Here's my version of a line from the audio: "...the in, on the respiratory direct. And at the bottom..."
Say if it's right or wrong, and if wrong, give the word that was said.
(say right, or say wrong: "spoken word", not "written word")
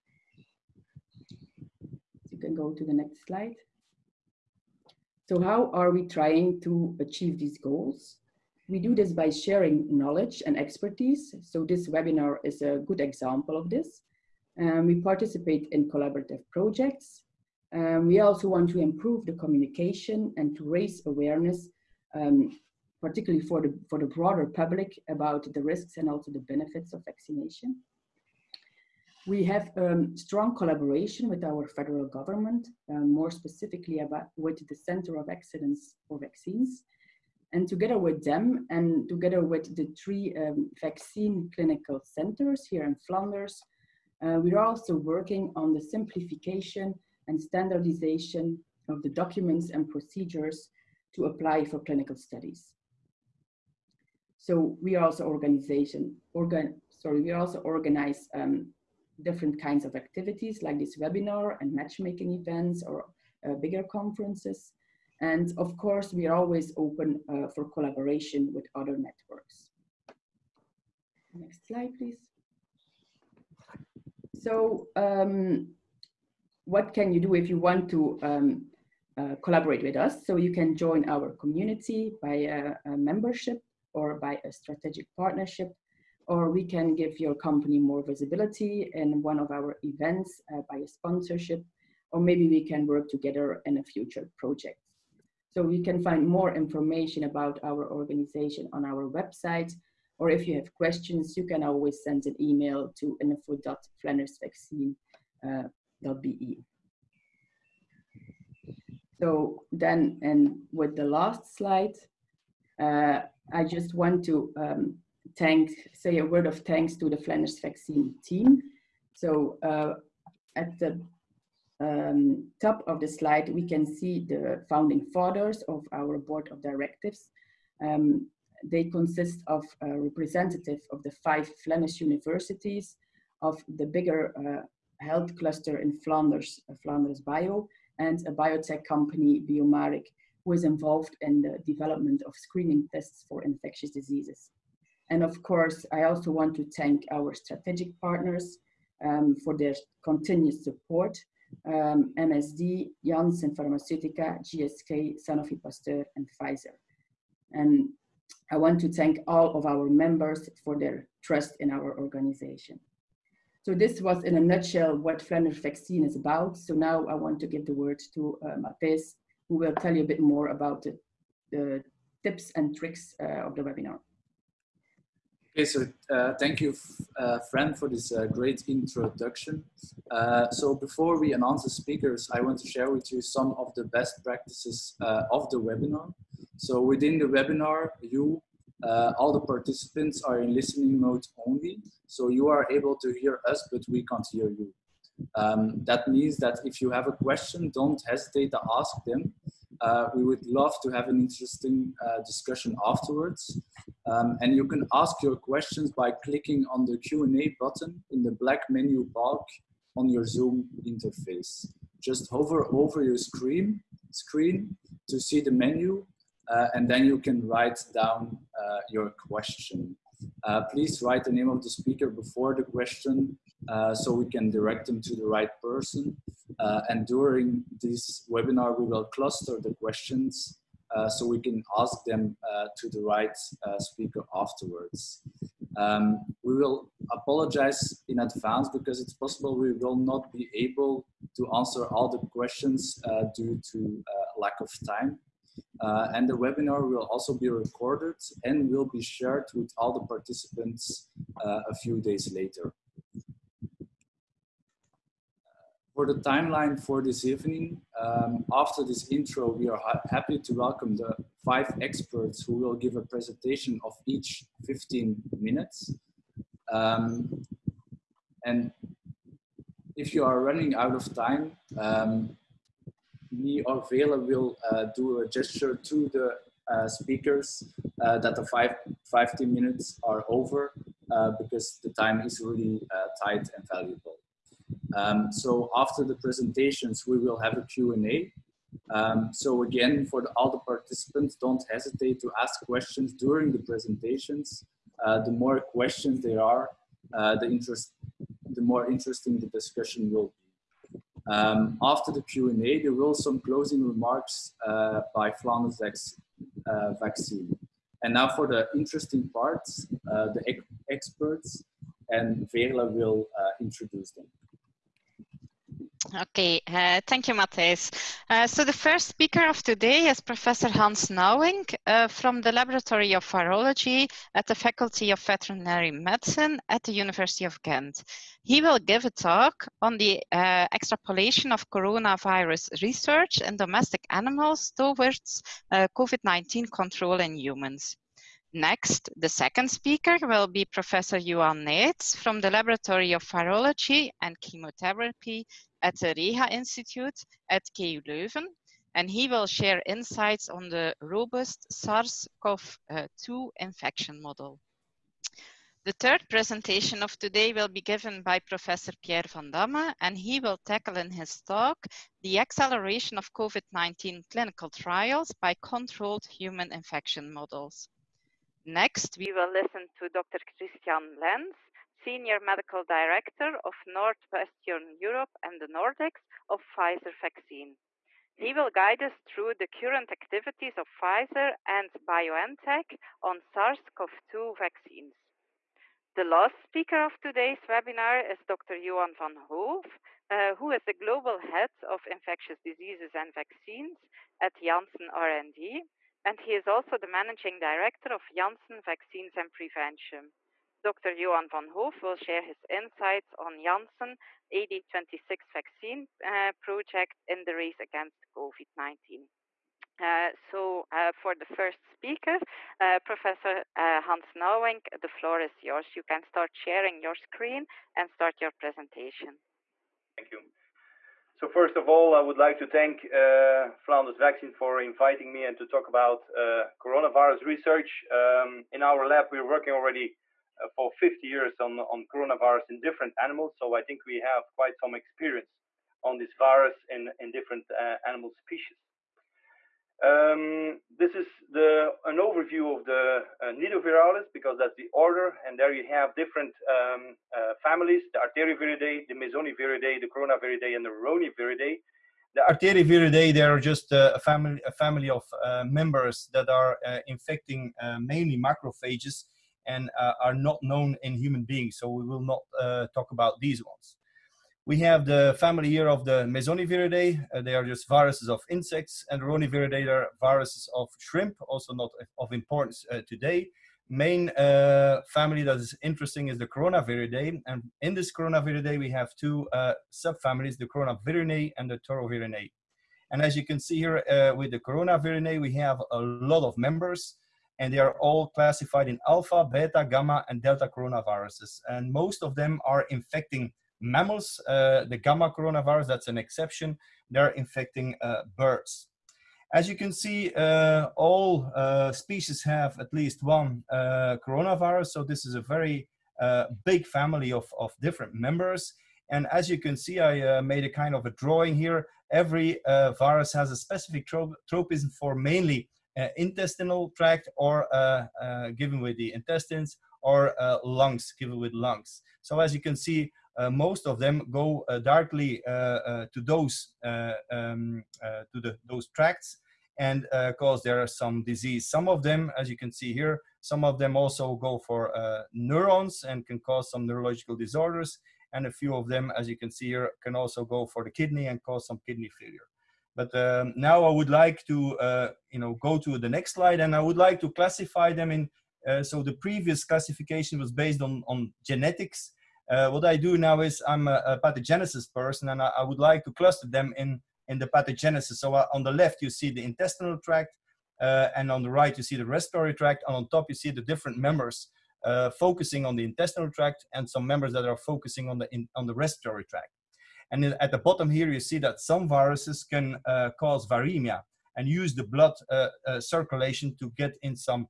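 wrong: "tract", not "direct".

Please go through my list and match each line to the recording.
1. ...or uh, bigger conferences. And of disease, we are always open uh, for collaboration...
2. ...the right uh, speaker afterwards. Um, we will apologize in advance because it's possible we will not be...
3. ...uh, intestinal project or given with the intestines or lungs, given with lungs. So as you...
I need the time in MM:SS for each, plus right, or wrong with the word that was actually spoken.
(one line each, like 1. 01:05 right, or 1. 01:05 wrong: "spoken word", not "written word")
1. 01:02 wrong: "course", not "disease"
2. 03:52 right
3. 08:35 wrong: "tract", not "project".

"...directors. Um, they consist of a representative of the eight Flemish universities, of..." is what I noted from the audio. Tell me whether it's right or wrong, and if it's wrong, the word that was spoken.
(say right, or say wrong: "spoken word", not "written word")
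wrong: "five", not "eight".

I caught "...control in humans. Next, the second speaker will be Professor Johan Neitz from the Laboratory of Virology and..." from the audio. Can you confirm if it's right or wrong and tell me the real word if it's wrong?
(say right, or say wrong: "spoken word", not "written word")
right.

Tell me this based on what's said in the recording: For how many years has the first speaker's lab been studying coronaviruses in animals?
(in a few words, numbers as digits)
50.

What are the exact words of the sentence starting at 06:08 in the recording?
Next, we will listen to Dr.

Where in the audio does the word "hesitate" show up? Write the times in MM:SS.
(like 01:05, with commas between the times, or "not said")
03:18, 04:51.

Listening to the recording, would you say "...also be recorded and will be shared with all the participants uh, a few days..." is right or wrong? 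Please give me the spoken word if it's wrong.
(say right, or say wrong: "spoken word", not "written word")
right.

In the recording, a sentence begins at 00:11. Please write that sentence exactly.
So this webinar is a good example of this.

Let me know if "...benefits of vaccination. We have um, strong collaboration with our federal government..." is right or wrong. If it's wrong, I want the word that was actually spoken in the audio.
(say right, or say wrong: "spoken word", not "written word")
right.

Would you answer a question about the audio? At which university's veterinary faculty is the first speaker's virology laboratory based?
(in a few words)
University of Ghent.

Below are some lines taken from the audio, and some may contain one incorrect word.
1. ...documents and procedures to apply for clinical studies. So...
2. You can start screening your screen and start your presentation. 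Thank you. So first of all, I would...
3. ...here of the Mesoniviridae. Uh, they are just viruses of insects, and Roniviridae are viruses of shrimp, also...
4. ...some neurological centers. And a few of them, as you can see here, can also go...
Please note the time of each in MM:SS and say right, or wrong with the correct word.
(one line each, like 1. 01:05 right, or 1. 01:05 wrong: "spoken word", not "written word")
1. 00:49 right
2. 06:55 wrong: "sharing", not "screening"
3. 07:45 right
4. 08:56 wrong: "disorders", not "centers".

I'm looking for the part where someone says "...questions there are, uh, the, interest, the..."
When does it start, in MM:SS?
04:55.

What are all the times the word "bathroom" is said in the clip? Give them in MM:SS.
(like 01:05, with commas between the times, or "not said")
not said.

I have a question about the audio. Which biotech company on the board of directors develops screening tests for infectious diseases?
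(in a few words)
Biomaric.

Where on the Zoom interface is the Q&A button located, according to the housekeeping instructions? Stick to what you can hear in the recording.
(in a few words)
black menu bar.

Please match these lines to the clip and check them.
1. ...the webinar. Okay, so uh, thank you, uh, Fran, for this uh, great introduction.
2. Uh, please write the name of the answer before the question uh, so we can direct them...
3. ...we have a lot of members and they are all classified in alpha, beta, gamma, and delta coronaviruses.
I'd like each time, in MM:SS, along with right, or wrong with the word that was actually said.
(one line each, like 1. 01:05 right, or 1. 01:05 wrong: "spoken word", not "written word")
1. 02:53 right
2. 03:40 wrong: "speaker", not "answer"
3. 08:05 right.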